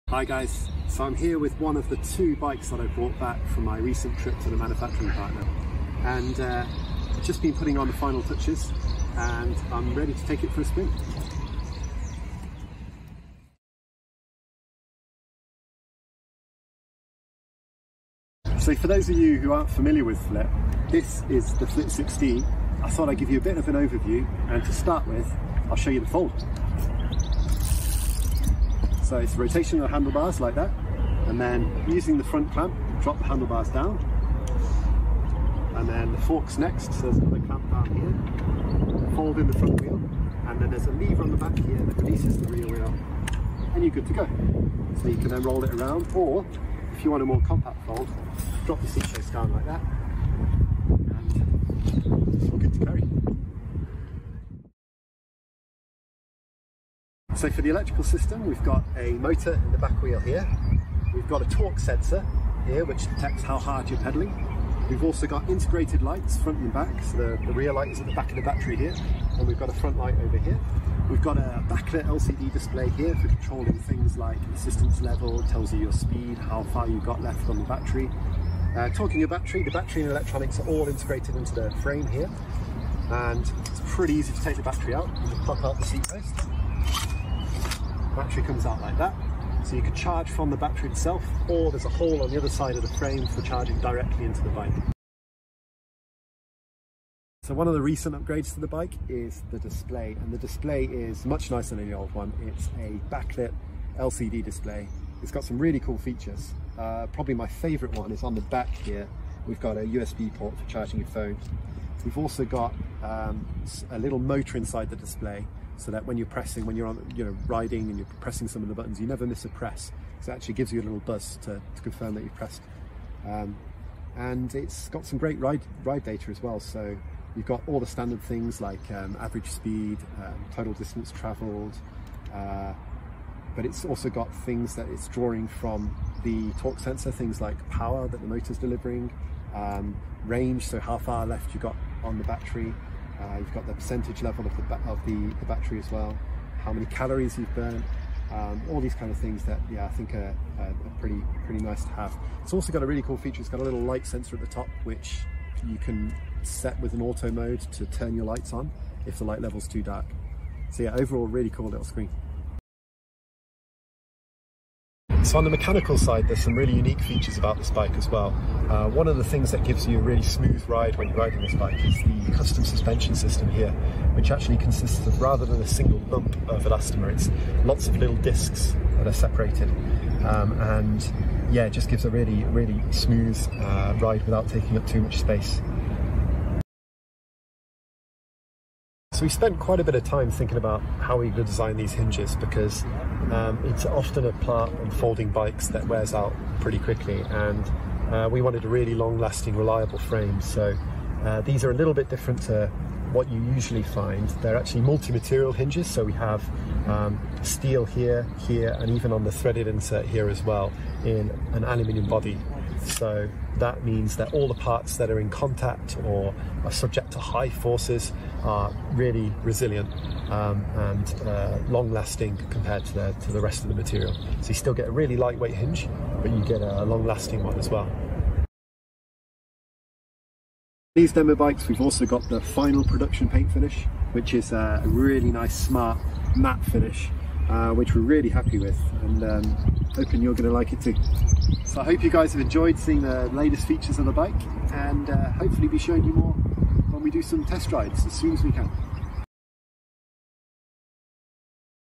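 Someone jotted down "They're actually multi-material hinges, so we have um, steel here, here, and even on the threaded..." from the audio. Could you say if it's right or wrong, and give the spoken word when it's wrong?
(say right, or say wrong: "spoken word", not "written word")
right.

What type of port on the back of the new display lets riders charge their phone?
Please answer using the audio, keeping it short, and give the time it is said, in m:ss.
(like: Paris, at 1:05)
USB port, at 1:49.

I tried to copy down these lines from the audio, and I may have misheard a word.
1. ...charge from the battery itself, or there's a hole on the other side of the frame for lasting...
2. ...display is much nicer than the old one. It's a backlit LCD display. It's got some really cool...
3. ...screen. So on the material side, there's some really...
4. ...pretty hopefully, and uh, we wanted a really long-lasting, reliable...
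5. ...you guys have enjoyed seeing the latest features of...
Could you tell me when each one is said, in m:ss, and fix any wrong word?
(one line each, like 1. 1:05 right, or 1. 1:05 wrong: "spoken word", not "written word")
1. 1:29 wrong: "charging", not "lasting"
2. 1:40 right
3. 2:41 wrong: "mechanical", not "material"
4. 3:16 wrong: "quickly", not "hopefully"
5. 4:02 right.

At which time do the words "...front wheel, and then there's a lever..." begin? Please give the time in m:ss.
0:39.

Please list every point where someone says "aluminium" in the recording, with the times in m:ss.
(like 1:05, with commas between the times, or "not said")
3:31.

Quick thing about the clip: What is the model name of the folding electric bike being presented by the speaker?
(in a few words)
FLIT 16.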